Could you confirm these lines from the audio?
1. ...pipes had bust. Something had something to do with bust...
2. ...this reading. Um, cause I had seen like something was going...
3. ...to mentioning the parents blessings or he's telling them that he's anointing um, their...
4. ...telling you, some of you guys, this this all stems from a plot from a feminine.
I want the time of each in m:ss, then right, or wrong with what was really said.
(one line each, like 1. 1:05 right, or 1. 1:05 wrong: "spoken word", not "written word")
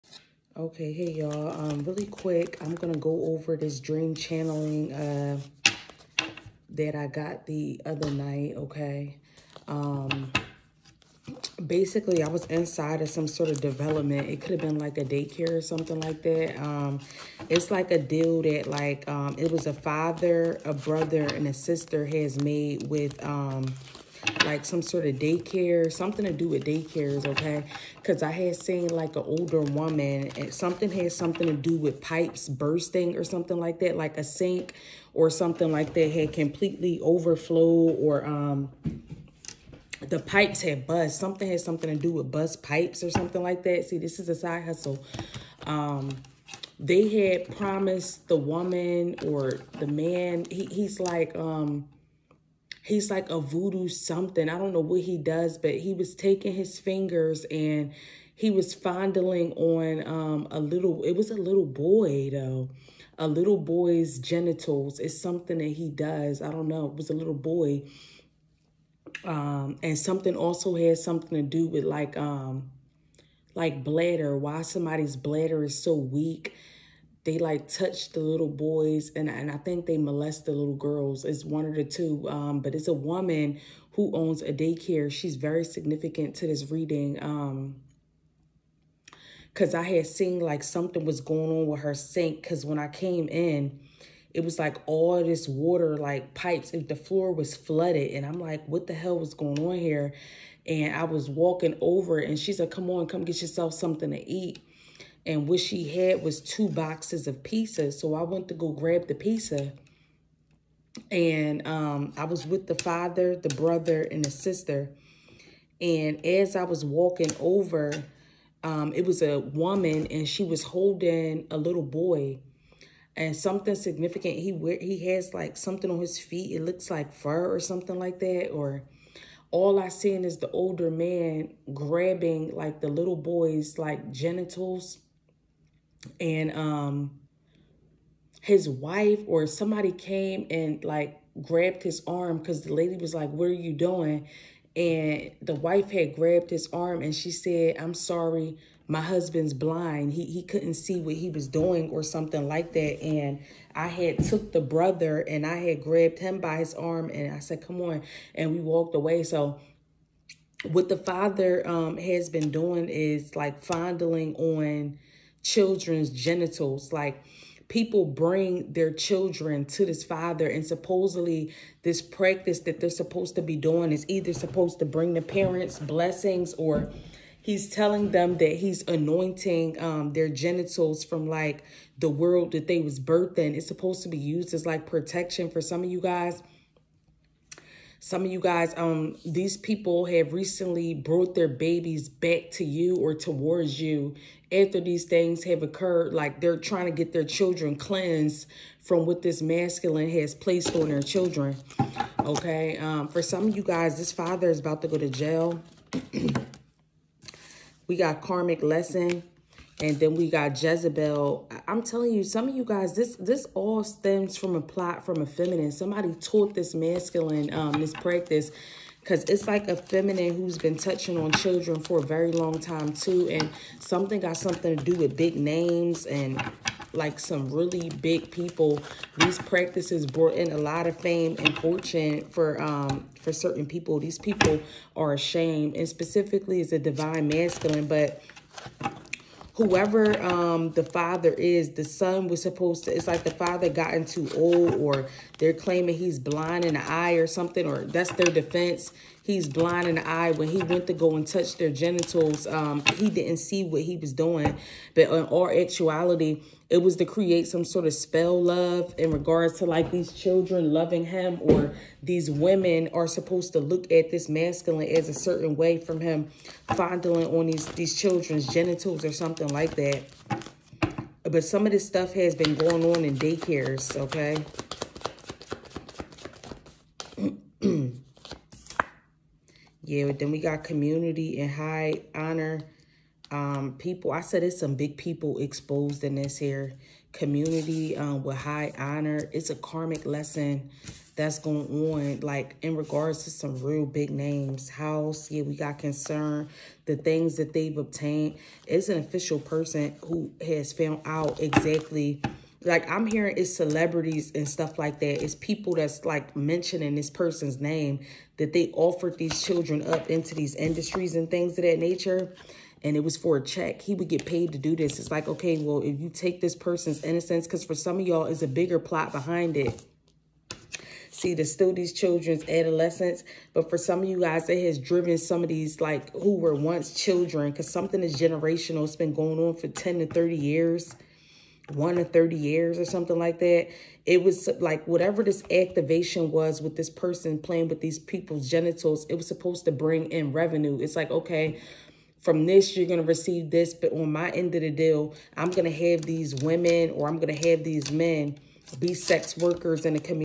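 1. 0:40 right
2. 1:26 right
3. 2:54 wrong: "bring", not "mentioning"
4. 3:31 right.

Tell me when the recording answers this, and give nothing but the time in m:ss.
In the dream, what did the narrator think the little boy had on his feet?
2:07.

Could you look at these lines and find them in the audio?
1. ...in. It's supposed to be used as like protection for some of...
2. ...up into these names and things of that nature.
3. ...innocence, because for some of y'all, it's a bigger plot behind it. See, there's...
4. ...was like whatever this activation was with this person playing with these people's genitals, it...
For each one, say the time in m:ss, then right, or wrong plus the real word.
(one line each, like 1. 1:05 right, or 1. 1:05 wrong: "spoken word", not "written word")
1. 3:03 right
2. 5:09 wrong: "industries", not "names"
3. 5:17 right
4. 5:34 right.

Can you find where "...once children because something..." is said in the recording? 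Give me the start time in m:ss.
5:26.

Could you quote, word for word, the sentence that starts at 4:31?
But some of this stuff has been going on in daycares, okay?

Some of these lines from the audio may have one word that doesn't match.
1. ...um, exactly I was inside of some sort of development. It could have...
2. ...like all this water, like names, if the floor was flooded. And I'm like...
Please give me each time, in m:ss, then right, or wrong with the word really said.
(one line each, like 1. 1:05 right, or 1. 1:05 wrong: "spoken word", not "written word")
1. 0:09 wrong: "basically", not "exactly"
2. 1:34 wrong: "pipes", not "names".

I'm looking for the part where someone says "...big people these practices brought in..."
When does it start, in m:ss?
3:48.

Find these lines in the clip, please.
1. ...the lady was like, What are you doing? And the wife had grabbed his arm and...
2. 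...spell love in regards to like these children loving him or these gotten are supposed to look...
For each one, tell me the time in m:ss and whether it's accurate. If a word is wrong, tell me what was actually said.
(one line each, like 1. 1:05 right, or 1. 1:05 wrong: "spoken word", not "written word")
1. 2:22 right
2. 4:17 wrong: "women", not "gotten".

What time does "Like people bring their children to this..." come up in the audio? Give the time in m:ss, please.
2:46.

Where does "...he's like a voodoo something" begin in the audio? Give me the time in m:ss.
0:52.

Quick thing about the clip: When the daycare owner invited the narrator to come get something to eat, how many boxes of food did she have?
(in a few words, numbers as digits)
2.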